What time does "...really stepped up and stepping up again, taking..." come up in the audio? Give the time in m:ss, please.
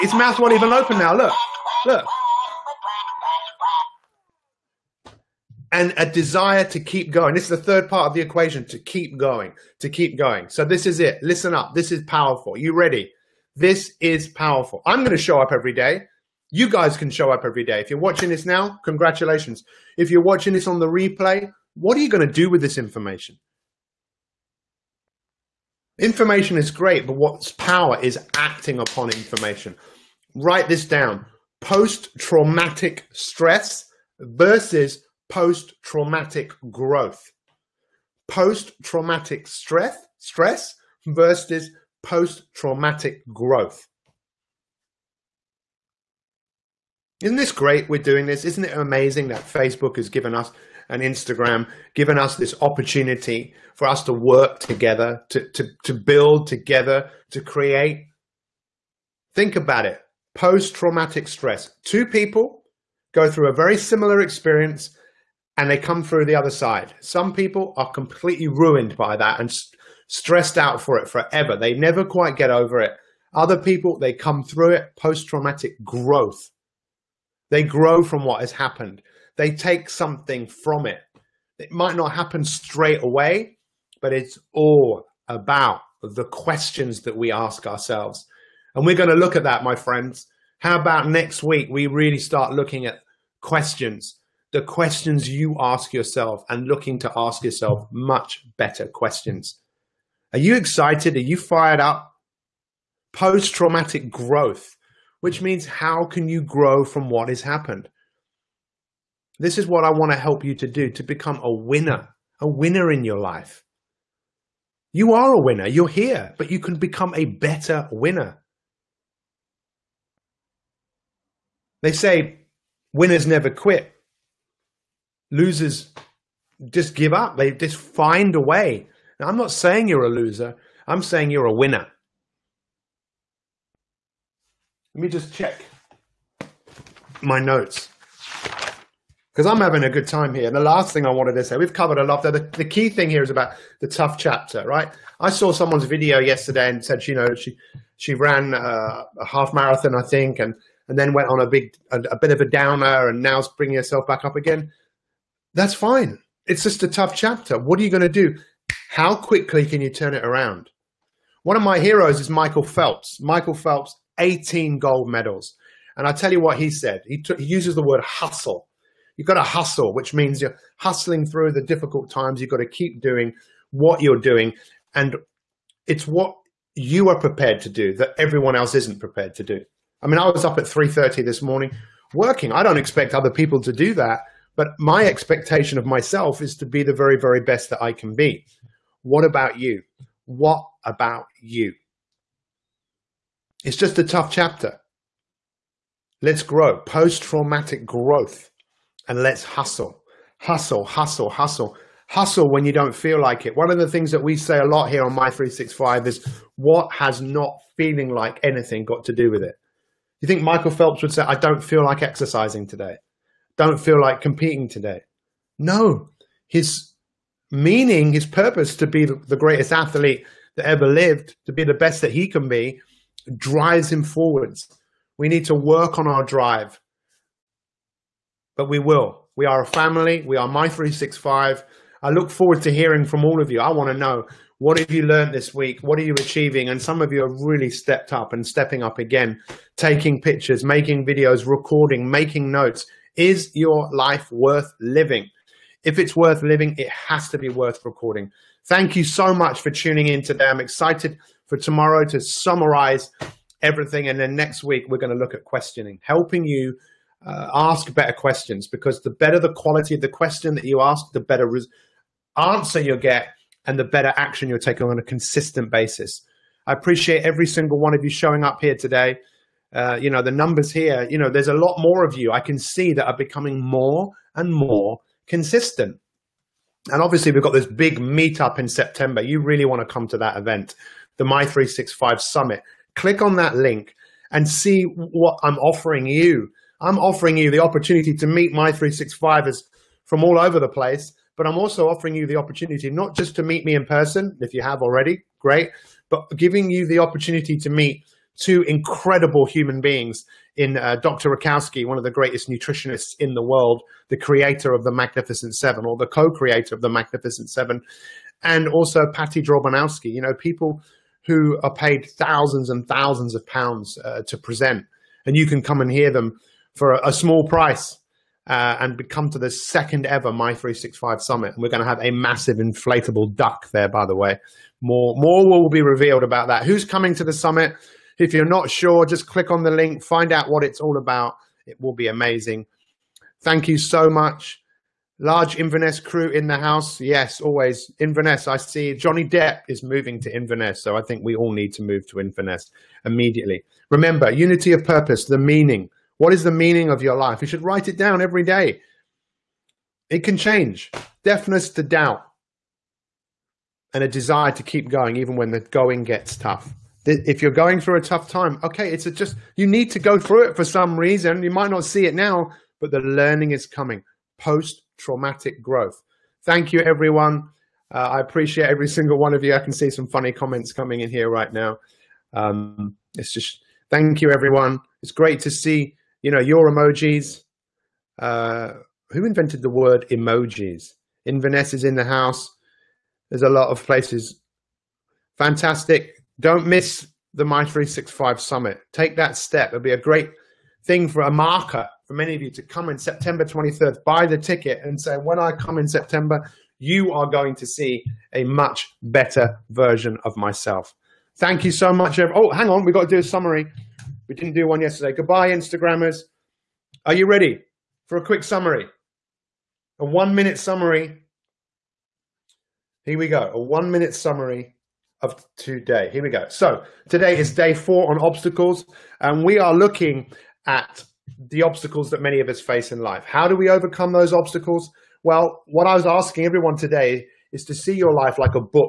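3:57.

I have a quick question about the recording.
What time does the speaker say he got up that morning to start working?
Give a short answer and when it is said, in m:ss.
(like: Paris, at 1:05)
3.30, at 3:00.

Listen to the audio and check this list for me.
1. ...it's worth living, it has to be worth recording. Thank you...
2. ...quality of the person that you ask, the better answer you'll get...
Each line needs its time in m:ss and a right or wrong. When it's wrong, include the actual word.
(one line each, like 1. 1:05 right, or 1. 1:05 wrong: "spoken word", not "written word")
1. 4:06 right
2. 4:19 wrong: "question", not "person".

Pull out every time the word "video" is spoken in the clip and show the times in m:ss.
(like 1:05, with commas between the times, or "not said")
2:25, 4:01.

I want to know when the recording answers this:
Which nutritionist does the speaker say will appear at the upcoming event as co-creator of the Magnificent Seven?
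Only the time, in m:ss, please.
5:01.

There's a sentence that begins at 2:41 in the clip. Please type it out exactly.
One of my heroes is Michael Phelps.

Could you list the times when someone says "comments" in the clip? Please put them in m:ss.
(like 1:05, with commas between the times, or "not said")
6:10.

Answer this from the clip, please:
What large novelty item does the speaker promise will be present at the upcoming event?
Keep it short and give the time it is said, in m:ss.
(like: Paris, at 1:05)
inflatable duck, at 5:22.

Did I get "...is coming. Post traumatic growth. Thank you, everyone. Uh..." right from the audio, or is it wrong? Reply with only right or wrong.
right.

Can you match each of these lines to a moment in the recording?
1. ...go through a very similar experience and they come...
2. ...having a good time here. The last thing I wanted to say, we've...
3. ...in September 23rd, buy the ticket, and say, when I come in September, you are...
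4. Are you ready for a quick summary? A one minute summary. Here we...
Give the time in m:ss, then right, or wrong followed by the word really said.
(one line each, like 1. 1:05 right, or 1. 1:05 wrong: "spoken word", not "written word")
1. 1:03 right
2. 2:19 right
3. 6:32 right
4. 6:47 right.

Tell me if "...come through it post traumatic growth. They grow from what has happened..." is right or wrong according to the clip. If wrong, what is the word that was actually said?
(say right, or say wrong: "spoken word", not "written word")
right.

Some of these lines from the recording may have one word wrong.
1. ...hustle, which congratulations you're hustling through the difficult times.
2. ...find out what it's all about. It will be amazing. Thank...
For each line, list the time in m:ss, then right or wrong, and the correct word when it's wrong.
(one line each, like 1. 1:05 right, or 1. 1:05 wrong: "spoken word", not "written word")
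1. 2:49 wrong: "means", not "congratulations"
2. 5:30 right.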